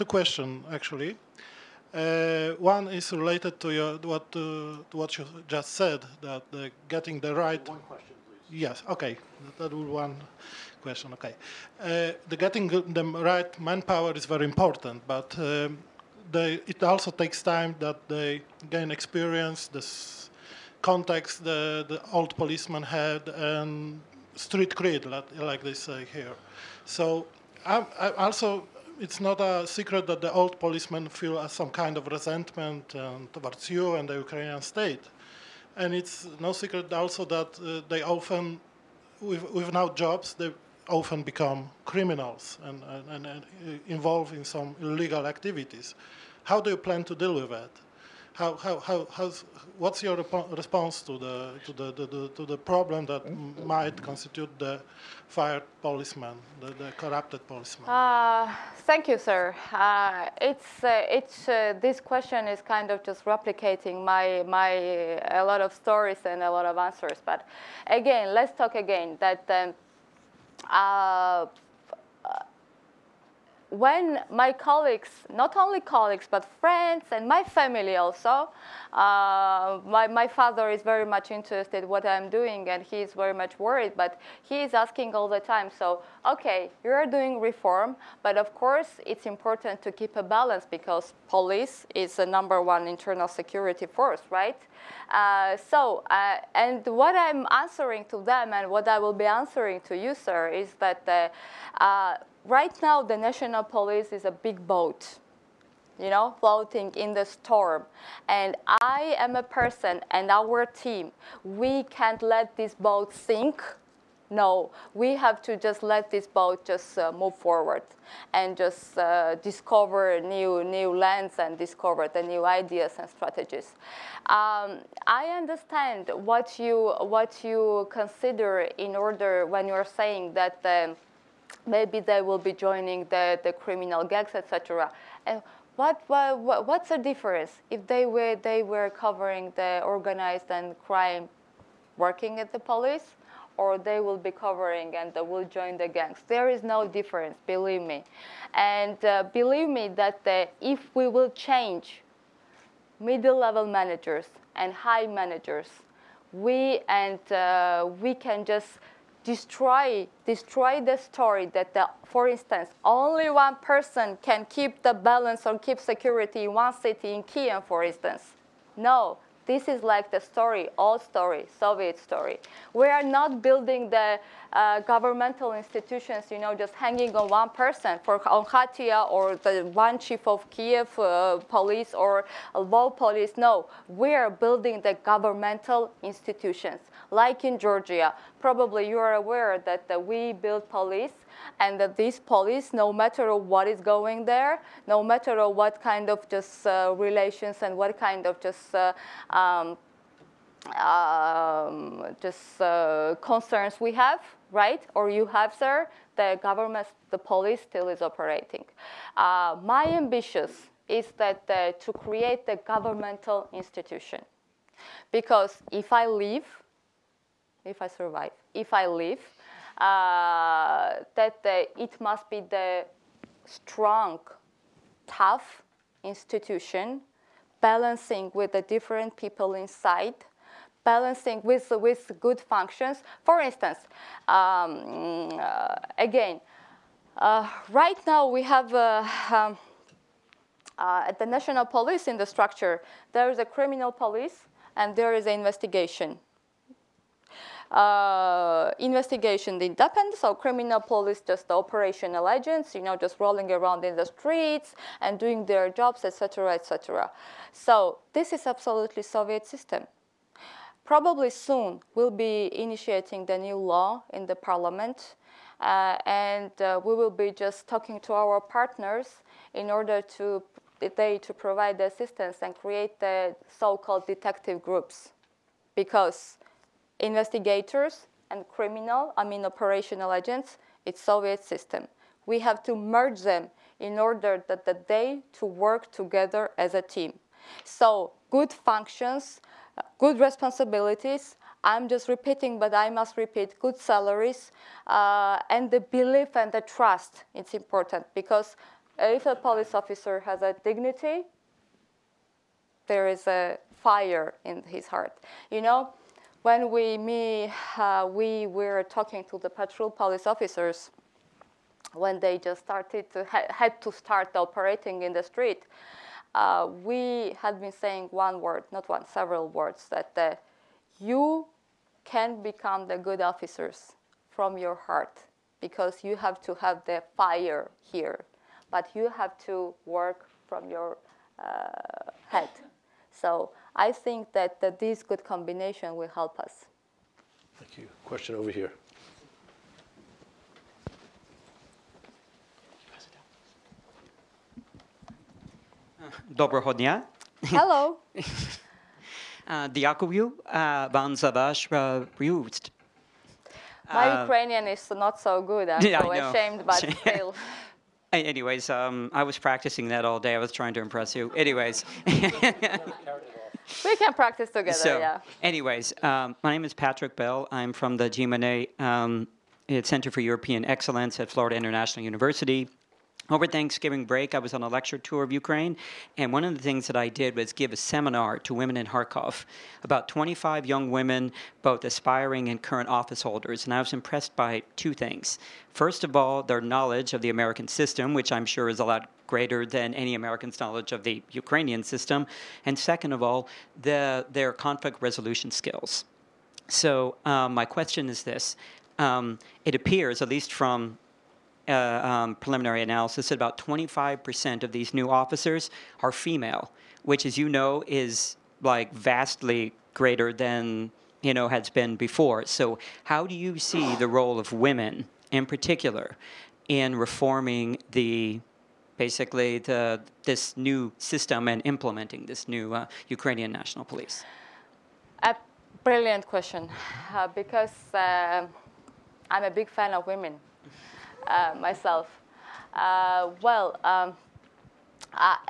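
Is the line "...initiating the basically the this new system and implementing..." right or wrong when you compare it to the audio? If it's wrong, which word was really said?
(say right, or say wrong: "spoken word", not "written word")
wrong: "reforming", not "initiating".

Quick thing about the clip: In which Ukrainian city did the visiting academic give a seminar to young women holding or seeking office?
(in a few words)
Kharkov.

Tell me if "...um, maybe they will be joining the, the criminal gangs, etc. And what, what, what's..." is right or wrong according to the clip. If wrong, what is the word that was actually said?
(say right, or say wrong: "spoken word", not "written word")
right.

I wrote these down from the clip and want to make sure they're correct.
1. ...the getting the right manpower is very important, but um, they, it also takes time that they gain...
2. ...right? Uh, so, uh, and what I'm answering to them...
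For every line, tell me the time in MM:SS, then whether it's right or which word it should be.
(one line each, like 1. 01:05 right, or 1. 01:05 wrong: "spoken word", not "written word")
1. 00:12 right
2. 01:34 right.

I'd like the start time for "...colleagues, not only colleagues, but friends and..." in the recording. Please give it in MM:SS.
01:14.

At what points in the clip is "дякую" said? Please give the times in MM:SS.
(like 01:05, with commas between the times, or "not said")
05:49.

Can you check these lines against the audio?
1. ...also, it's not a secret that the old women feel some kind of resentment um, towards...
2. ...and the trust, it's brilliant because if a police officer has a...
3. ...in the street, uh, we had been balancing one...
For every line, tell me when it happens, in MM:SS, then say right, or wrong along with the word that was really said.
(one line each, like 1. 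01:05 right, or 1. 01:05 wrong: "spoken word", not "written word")
1. 00:28 wrong: "policemen", not "women"
2. 04:56 wrong: "important", not "brilliant"
3. 05:15 wrong: "saying", not "balancing".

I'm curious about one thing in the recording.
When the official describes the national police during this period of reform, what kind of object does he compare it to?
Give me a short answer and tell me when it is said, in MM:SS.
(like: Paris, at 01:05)
A big boat, at 01:44.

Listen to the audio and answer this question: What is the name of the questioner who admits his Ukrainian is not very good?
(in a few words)
Patrick Bell.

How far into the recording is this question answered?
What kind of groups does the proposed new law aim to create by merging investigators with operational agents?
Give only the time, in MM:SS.
04:34.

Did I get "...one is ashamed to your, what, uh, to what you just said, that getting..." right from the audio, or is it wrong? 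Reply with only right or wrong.
wrong.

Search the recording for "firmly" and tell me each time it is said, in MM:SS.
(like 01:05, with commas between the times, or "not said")
not said.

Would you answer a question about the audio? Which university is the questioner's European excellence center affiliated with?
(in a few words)
Florida International University.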